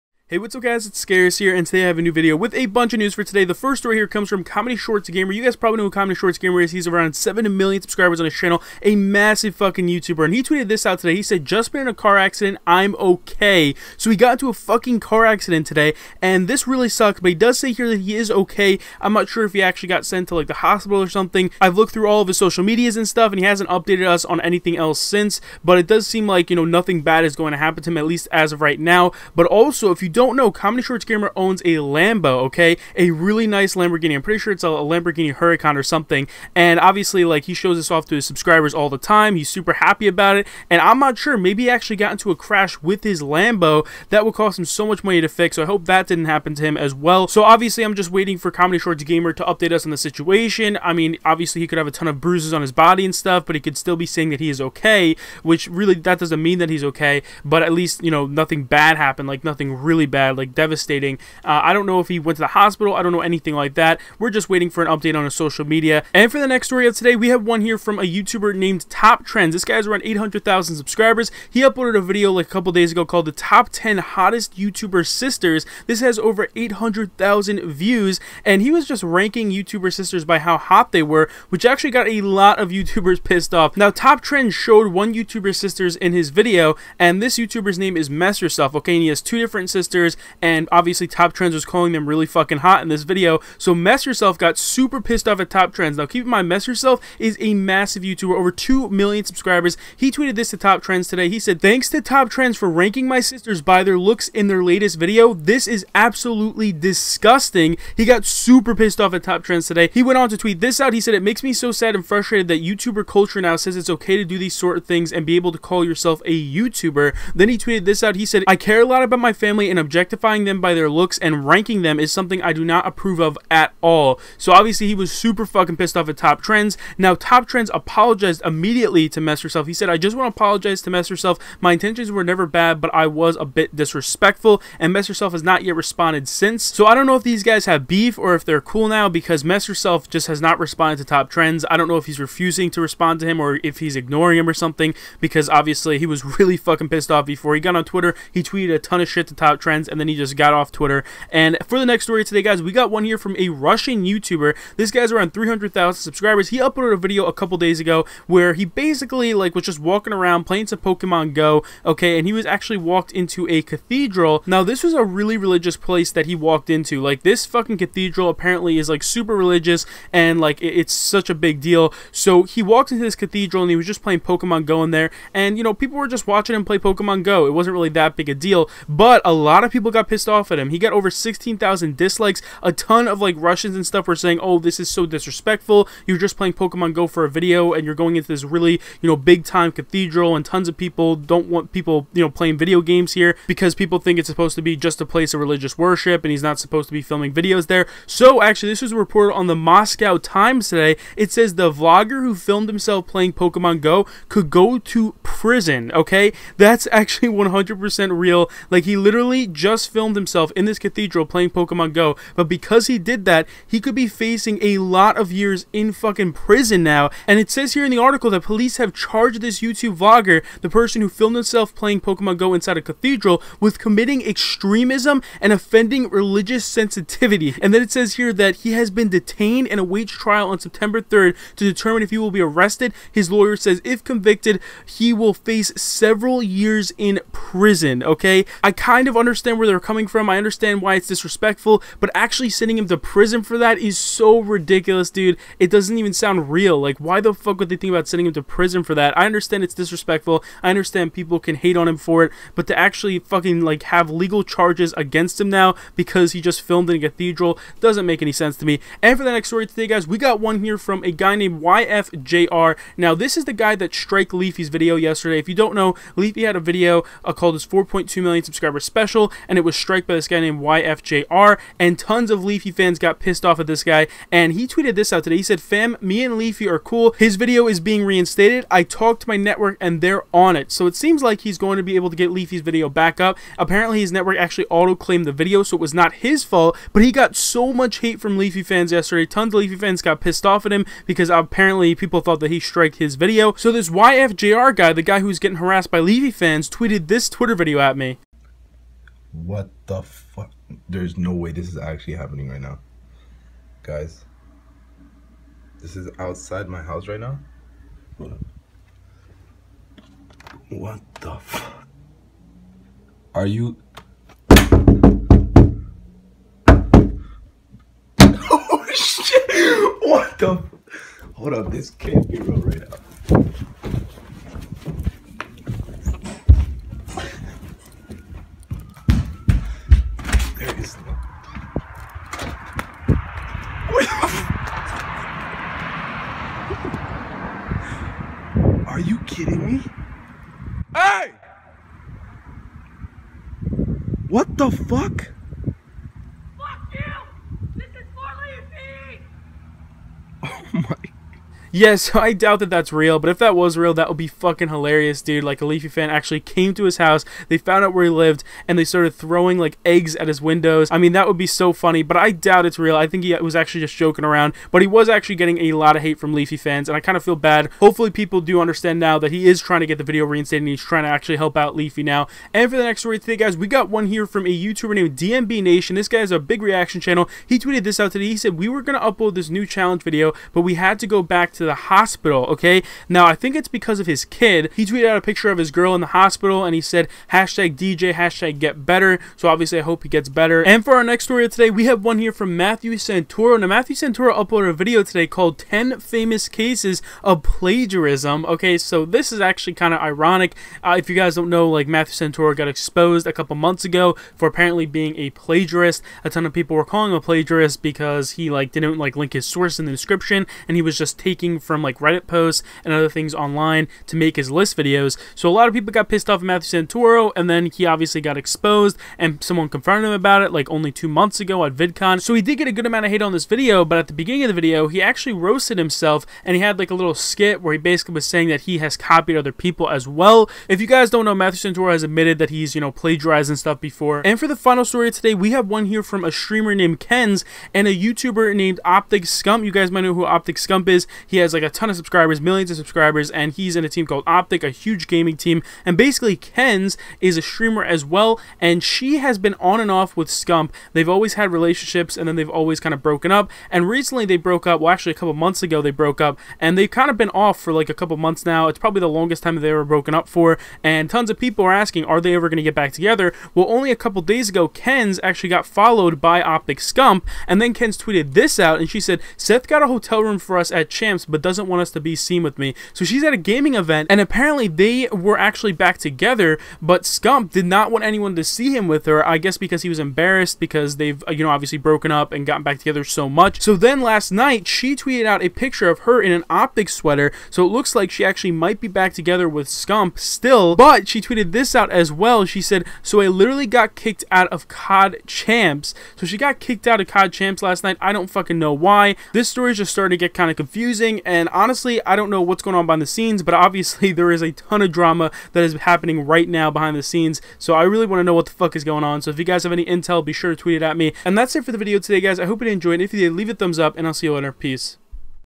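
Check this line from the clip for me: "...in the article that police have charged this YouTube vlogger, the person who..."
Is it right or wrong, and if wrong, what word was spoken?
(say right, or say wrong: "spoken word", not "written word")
right.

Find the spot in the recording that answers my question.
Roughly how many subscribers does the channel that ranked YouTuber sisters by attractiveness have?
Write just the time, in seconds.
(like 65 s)
69 s.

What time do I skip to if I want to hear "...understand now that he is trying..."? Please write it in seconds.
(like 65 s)
368 s.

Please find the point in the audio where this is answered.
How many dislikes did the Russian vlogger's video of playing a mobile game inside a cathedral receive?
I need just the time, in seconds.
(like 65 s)
180 s.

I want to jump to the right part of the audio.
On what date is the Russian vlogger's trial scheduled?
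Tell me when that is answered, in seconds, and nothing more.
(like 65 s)
230 s.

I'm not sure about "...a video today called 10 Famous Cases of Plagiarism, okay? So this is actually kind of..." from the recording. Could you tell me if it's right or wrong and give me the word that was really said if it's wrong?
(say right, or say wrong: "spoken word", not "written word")
right.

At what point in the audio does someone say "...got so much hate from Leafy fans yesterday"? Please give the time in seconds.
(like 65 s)
287 s.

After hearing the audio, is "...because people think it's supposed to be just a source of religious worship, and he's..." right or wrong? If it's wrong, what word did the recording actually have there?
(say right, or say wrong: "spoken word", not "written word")
wrong: "place", not "source".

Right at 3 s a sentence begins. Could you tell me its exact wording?
The first story here comes from Comedy Shorts Gamer.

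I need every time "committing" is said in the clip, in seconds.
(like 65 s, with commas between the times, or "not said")
223 s.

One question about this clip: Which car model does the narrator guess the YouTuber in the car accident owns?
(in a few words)
Lamborghini Huracan.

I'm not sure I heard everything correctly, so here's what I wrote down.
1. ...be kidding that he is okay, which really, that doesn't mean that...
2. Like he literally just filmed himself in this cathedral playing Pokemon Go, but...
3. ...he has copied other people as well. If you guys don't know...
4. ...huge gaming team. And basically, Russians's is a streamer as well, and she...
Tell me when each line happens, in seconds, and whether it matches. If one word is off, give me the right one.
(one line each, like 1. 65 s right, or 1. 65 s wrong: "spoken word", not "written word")
1. 53 s wrong: "saying", not "kidding"
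2. 208 s right
3. 428 s right
4. 444 s wrong: "Ken", not "Russians".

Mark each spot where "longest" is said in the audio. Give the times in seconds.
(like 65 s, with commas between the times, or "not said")
459 s.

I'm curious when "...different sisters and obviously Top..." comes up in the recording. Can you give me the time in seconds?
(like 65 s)
89 s.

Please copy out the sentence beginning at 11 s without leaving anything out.
He said, just been in a car accident, I'm okay.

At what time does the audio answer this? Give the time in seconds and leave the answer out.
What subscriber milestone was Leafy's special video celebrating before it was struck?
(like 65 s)
267 s.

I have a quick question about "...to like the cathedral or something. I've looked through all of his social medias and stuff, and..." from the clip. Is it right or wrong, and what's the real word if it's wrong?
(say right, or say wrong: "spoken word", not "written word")
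wrong: "hospital", not "cathedral".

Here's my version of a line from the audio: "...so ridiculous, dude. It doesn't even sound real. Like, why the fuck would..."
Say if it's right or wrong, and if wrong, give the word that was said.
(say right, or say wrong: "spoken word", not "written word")
right.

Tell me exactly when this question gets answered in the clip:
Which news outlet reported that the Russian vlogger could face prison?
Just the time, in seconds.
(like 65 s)
199 s.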